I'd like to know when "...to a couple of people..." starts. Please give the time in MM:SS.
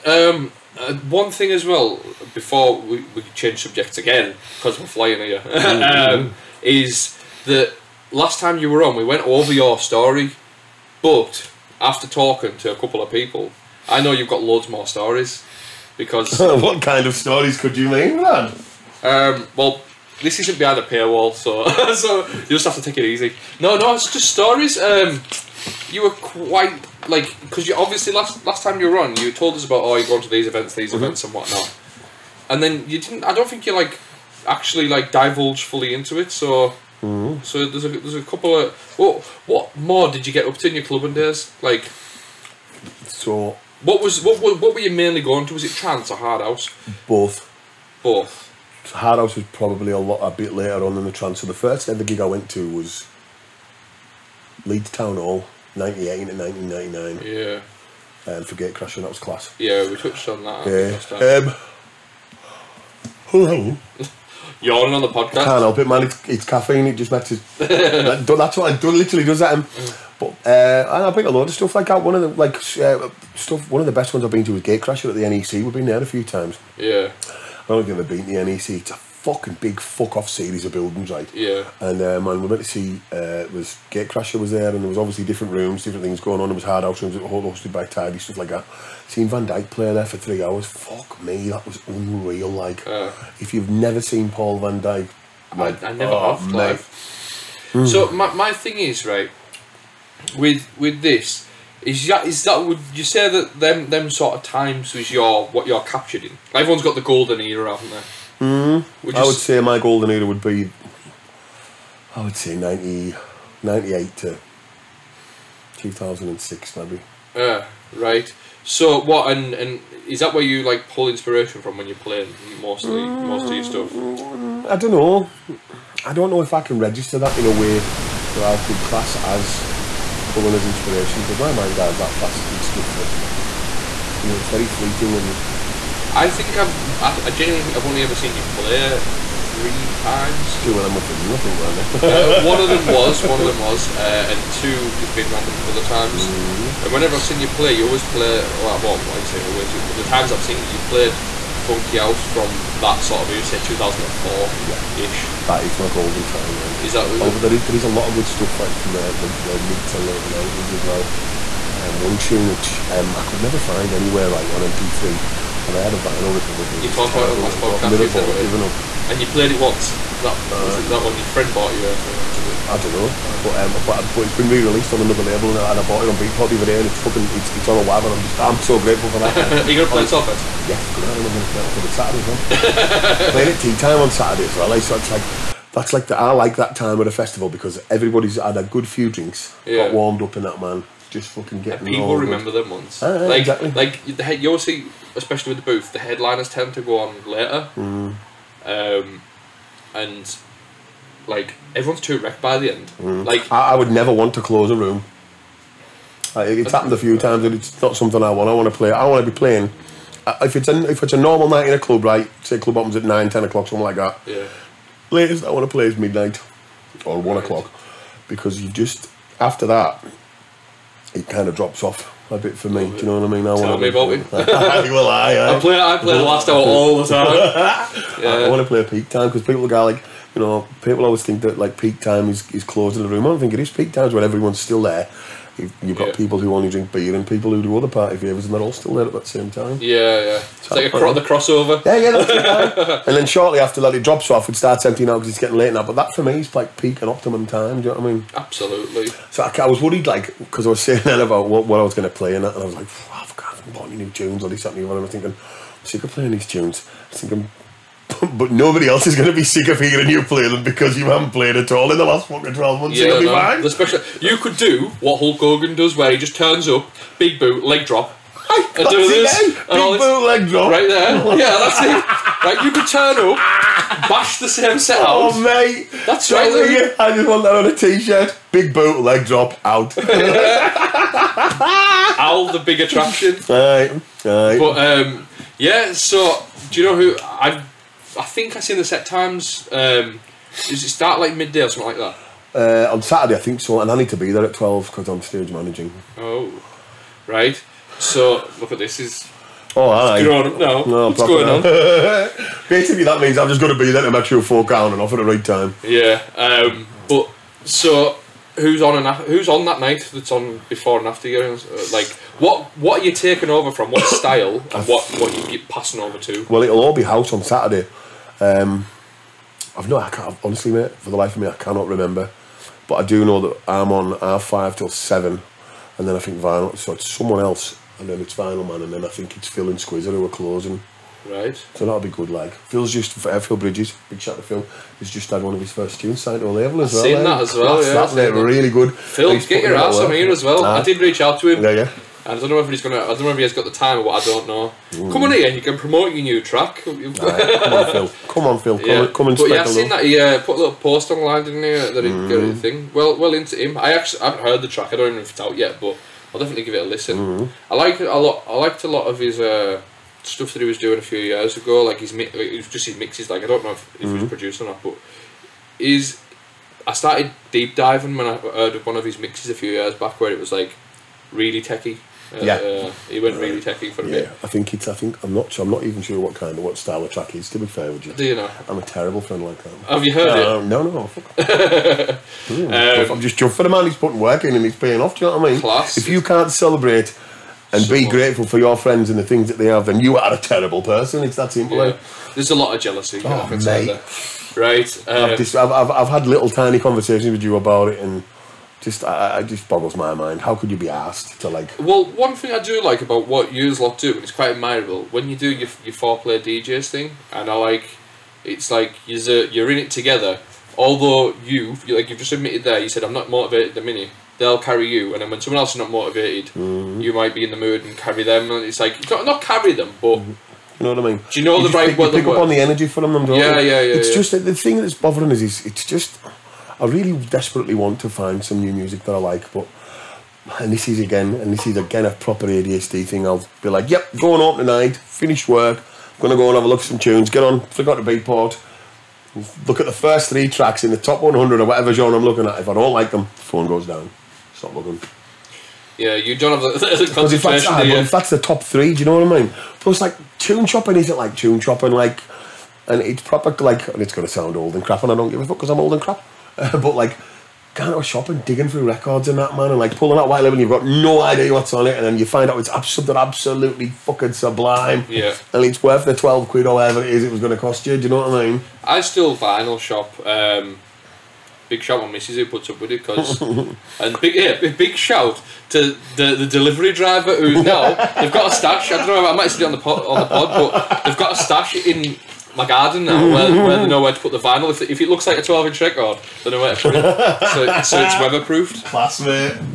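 00:12.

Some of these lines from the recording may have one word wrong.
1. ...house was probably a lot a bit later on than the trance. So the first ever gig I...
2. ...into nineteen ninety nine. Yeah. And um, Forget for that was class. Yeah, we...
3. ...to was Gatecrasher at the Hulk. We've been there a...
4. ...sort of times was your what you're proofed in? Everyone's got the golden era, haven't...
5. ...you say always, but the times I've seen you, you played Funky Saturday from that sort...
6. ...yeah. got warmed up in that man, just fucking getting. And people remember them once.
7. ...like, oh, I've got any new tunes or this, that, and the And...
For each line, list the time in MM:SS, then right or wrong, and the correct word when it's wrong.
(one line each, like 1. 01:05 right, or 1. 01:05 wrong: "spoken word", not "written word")
1. 00:49 right
2. 00:56 right
3. 01:14 wrong: "NEC", not "Hulk"
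4. 01:44 wrong: "captured", not "proofed"
5. 02:29 wrong: "House", not "Saturday"
6. 03:09 right
7. 04:12 right.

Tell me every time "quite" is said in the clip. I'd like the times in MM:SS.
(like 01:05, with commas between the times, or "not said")
00:26, 06:44.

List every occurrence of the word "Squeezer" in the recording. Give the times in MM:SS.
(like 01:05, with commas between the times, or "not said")
05:29.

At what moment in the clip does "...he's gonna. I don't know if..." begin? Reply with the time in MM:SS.
05:42.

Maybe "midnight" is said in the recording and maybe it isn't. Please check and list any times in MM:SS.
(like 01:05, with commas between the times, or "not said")
03:35.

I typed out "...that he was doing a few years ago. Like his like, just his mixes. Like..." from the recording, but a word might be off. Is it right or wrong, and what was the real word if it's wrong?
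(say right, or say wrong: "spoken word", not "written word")
right.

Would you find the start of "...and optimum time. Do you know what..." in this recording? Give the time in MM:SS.
04:07.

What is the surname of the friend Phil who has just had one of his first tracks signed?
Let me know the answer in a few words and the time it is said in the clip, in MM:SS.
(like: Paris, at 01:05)
Bridges, at 05:33.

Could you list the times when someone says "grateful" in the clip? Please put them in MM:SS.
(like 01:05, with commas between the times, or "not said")
02:58, 06:28.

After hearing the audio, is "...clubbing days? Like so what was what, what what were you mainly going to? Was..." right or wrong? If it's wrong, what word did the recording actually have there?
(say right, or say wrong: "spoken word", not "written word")
right.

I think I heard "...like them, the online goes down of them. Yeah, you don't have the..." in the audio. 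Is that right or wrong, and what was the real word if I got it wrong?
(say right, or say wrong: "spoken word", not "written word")
wrong: "phone", not "online".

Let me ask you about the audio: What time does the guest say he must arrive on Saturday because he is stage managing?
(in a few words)
12.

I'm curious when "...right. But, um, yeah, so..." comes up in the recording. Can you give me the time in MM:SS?
04:44.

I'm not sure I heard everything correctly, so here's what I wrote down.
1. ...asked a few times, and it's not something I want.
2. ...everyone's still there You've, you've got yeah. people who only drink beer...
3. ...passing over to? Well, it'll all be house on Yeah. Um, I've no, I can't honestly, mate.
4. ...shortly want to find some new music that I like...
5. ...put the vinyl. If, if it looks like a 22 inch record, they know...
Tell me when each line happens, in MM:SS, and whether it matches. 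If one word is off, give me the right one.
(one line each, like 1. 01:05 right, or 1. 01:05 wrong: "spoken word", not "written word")
1. 03:26 wrong: "happened", not "asked"
2. 03:54 right
3. 05:15 wrong: "Saturday", not "Yeah"
4. 07:07 wrong: "desperately", not "shortly"
5. 08:04 wrong: "12", not "22".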